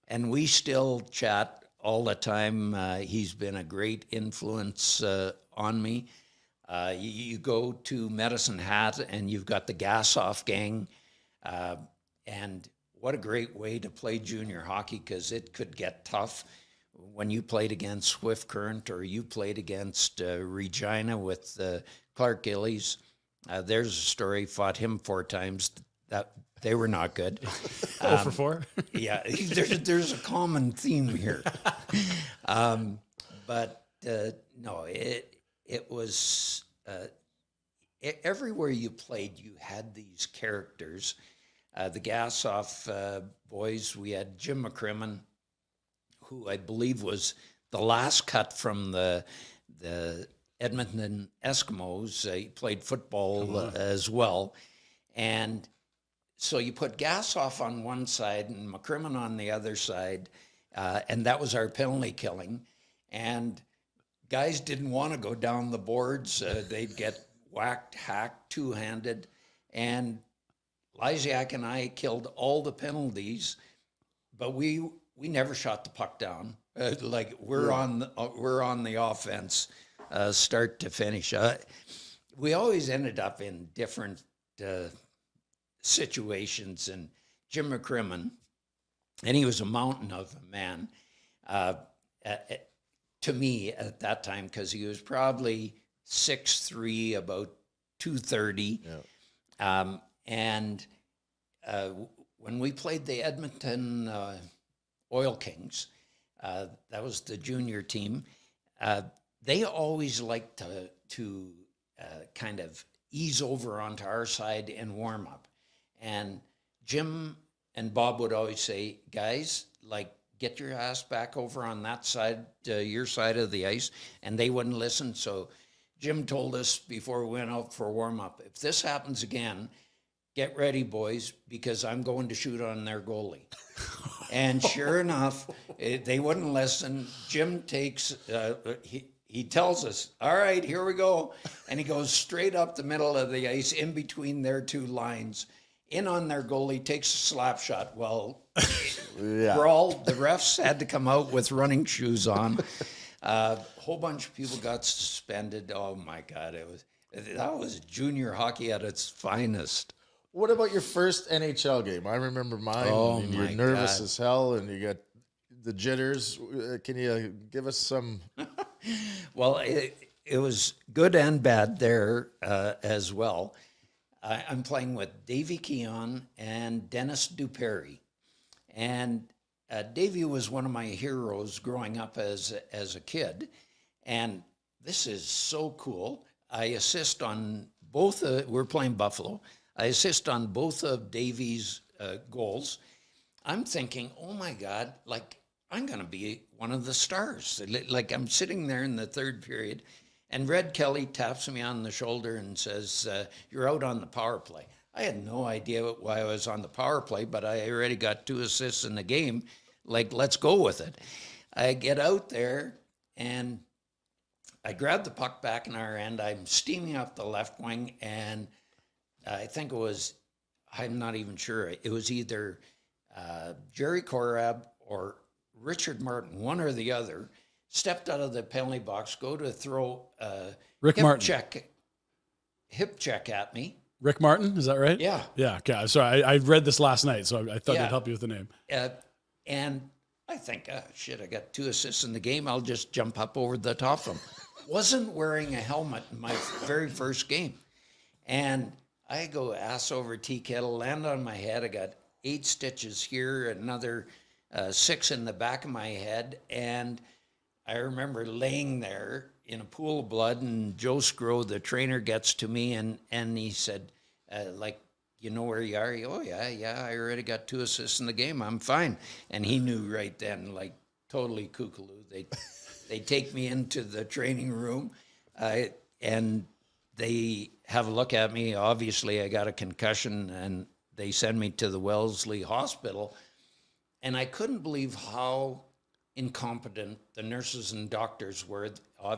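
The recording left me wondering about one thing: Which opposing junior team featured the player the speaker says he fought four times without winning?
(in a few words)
Regina.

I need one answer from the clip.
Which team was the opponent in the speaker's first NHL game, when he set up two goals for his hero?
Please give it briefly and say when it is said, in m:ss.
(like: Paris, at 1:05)
Buffalo, at 3:08.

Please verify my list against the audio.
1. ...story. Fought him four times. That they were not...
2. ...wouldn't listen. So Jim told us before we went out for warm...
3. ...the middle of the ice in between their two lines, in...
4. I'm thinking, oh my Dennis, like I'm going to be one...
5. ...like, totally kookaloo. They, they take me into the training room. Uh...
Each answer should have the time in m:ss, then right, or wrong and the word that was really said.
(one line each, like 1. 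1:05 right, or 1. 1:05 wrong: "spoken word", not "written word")
1. 0:23 right
2. 2:04 right
3. 2:22 right
4. 3:13 wrong: "God", not "Dennis"
5. 4:30 right.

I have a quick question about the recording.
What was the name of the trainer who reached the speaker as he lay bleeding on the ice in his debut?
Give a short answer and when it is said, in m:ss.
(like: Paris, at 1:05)
Joe Sgro, at 4:20.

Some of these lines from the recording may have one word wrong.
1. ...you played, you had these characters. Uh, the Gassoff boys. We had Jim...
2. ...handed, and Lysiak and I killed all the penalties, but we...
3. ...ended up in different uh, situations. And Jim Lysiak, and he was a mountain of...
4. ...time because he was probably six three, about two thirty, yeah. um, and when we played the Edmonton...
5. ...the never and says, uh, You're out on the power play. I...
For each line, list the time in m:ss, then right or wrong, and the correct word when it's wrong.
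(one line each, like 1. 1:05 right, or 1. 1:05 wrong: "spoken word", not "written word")
1. 0:38 right
2. 1:08 right
3. 1:22 wrong: "McCrimmon", not "Lysiak"
4. 1:34 right
5. 3:21 wrong: "shoulder", not "never".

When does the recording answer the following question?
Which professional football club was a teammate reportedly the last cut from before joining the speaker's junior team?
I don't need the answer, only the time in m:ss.
0:50.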